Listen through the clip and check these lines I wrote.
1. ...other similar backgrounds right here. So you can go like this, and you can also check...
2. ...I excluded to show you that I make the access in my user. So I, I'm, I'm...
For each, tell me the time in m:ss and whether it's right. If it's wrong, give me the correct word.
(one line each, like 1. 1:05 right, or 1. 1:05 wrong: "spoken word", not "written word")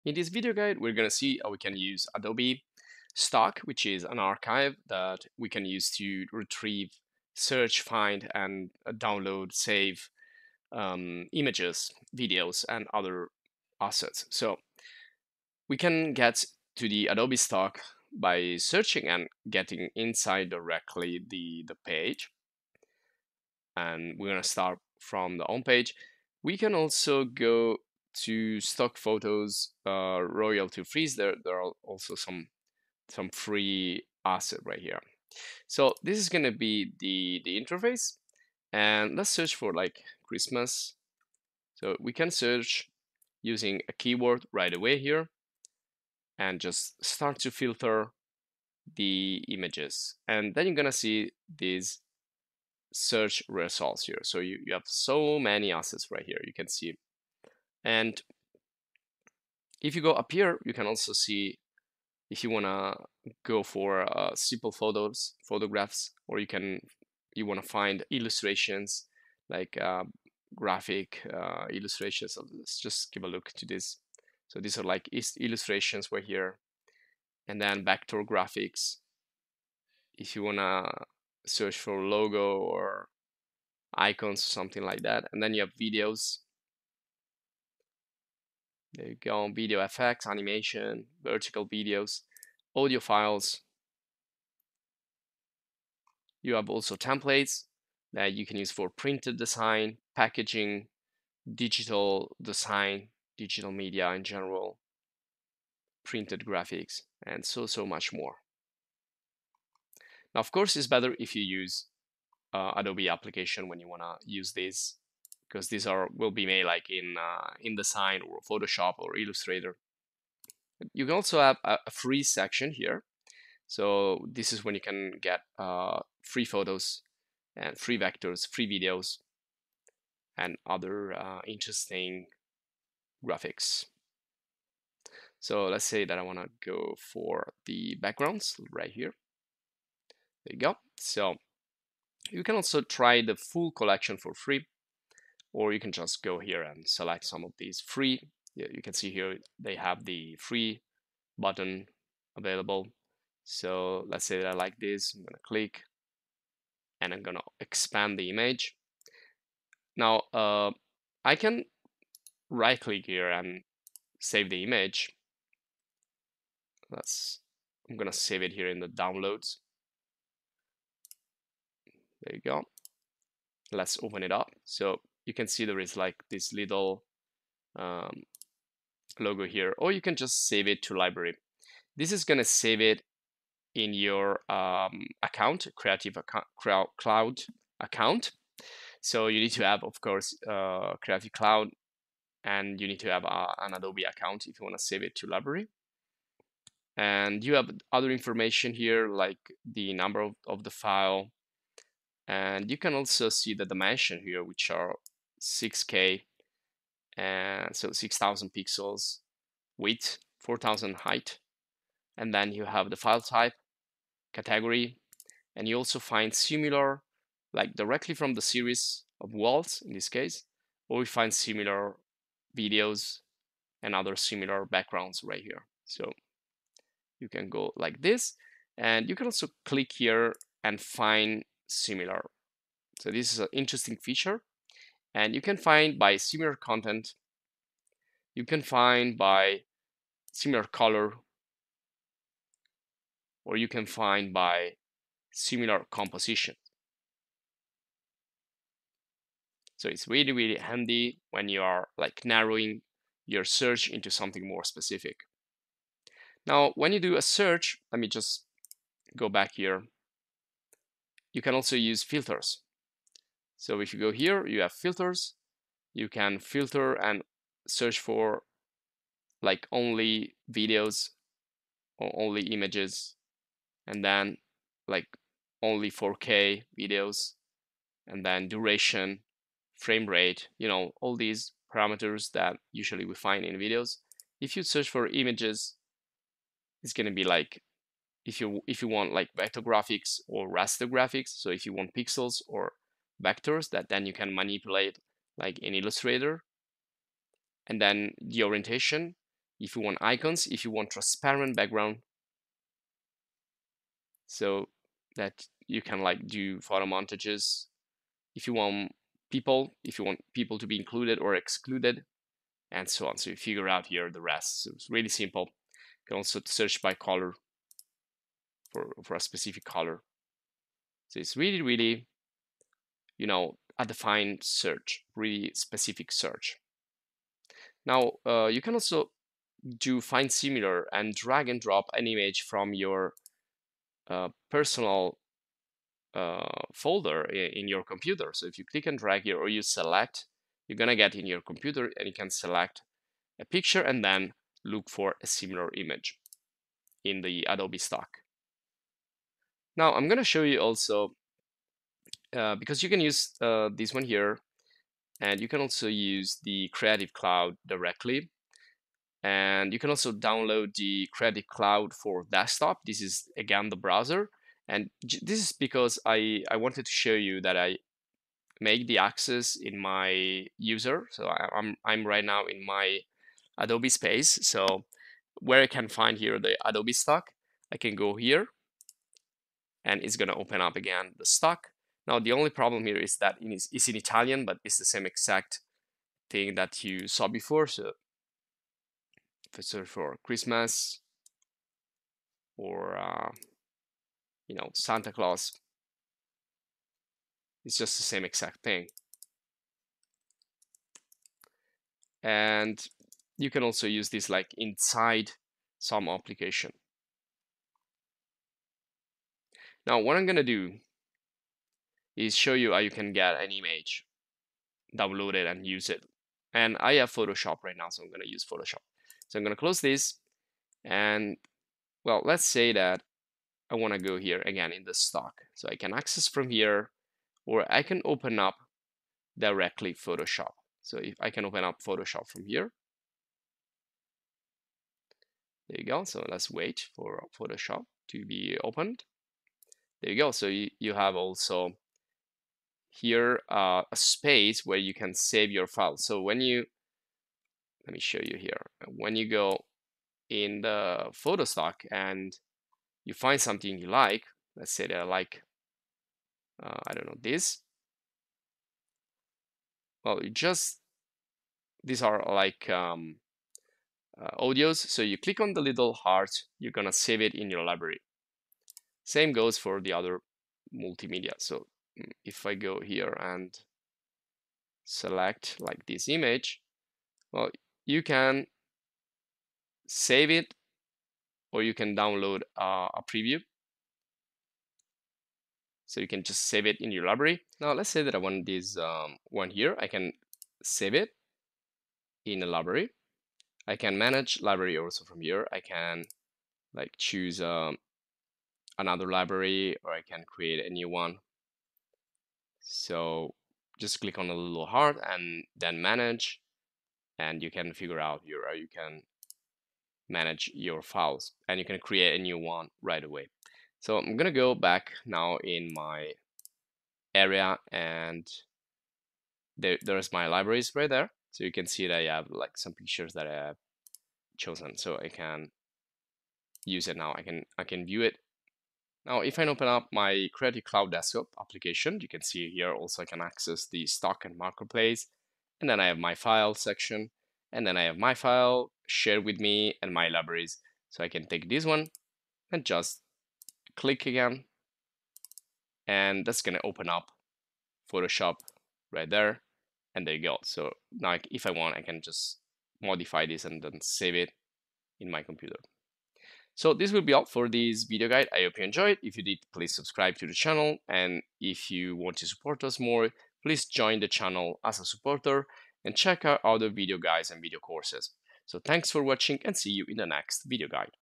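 1. 3:43 wrong: "click", not "check"
2. 6:06 wrong: "wanted", not "excluded".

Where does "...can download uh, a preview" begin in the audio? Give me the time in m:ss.
8:01.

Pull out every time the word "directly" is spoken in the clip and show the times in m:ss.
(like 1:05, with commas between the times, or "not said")
0:20, 3:37, 5:57, 7:09.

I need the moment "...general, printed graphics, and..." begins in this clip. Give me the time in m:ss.
1:44.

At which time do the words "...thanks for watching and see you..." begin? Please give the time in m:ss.
9:28.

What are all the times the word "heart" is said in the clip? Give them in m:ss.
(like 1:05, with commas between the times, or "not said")
7:45, 8:24.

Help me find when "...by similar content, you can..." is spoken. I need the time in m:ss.
3:55.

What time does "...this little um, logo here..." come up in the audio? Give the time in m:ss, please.
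2:56.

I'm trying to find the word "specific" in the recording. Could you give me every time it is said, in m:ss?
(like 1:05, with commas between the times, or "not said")
4:14, 5:19, 5:25.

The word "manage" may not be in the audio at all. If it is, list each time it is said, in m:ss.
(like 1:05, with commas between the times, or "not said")
8:13, 8:25, 8:30.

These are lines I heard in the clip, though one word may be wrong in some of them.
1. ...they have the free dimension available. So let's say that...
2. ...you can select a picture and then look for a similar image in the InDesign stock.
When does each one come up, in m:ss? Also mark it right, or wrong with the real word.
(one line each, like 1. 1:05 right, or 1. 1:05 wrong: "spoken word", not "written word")
1. 2:29 wrong: "button", not "dimension"
2. 5:42 wrong: "Adobe", not "InDesign".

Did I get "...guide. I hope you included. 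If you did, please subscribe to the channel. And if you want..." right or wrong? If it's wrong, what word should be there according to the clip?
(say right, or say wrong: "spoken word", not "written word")
wrong: "enjoyed", not "included".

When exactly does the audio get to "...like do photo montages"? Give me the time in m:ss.
5:06.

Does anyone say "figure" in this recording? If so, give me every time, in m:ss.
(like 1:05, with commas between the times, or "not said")
5:13, 8:27.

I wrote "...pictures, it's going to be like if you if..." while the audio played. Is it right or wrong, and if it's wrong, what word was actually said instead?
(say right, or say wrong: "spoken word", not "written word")
wrong: "images", not "pictures".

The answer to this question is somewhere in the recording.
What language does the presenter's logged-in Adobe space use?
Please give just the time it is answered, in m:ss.
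6:23.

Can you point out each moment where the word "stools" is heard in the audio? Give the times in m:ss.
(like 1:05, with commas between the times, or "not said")
not said.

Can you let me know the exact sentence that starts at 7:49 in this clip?
Same goes for the other multimedia.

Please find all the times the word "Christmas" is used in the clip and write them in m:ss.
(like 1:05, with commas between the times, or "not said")
0:40, 6:30.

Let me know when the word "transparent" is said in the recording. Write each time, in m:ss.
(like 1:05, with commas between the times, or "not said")
5:00.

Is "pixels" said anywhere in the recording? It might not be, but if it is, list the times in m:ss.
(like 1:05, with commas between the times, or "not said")
3:28, 4:51.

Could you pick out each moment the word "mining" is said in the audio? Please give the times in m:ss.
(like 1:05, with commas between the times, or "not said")
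not said.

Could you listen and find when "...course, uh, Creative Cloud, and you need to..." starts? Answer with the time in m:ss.
3:10.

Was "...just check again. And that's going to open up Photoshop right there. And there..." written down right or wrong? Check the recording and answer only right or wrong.
wrong.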